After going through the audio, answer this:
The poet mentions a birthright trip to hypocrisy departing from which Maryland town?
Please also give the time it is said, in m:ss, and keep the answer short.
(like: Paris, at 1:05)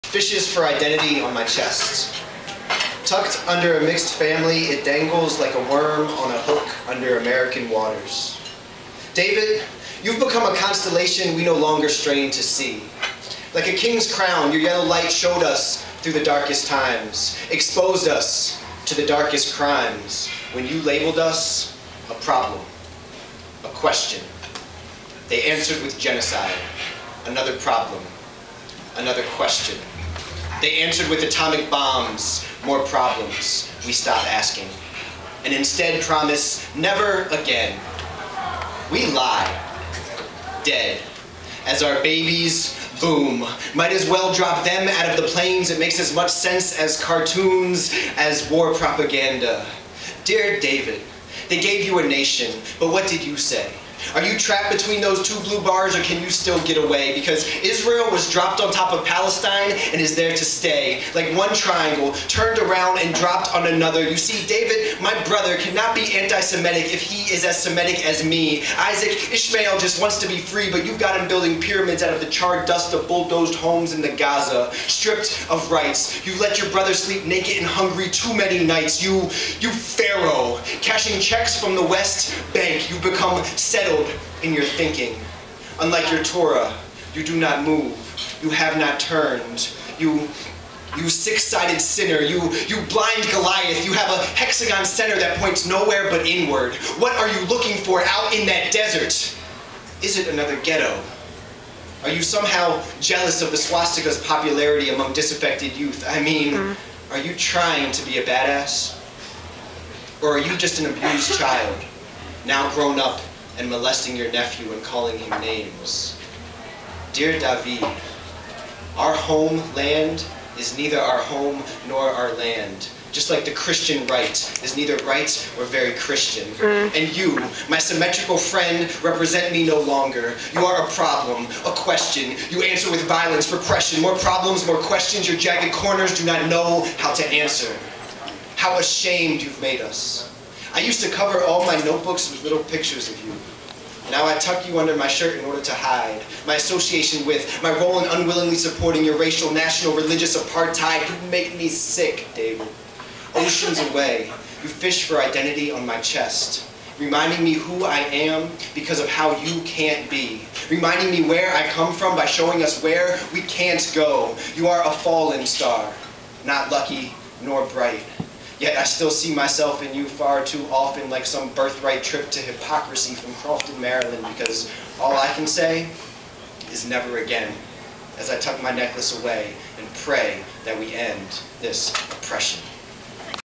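Crofton, at 2:53.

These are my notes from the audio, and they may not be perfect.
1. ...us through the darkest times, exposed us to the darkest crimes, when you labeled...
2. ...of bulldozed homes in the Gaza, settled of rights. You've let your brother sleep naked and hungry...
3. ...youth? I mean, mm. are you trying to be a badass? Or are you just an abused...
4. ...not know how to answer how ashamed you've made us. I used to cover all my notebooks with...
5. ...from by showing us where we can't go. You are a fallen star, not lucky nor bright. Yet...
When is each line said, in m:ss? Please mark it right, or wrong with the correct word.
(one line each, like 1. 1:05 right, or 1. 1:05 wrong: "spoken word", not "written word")
1. 0:15 right
2. 1:12 wrong: "stripped", not "settled"
3. 1:45 right
4. 2:16 right
5. 2:41 right.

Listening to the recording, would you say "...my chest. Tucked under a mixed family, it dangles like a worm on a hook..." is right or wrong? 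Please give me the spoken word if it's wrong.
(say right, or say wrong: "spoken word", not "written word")
right.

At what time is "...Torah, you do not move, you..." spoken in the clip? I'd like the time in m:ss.
1:26.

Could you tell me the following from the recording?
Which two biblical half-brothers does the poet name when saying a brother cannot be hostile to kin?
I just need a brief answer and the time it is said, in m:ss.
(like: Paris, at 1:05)
Isaac, Ishmael, at 1:08.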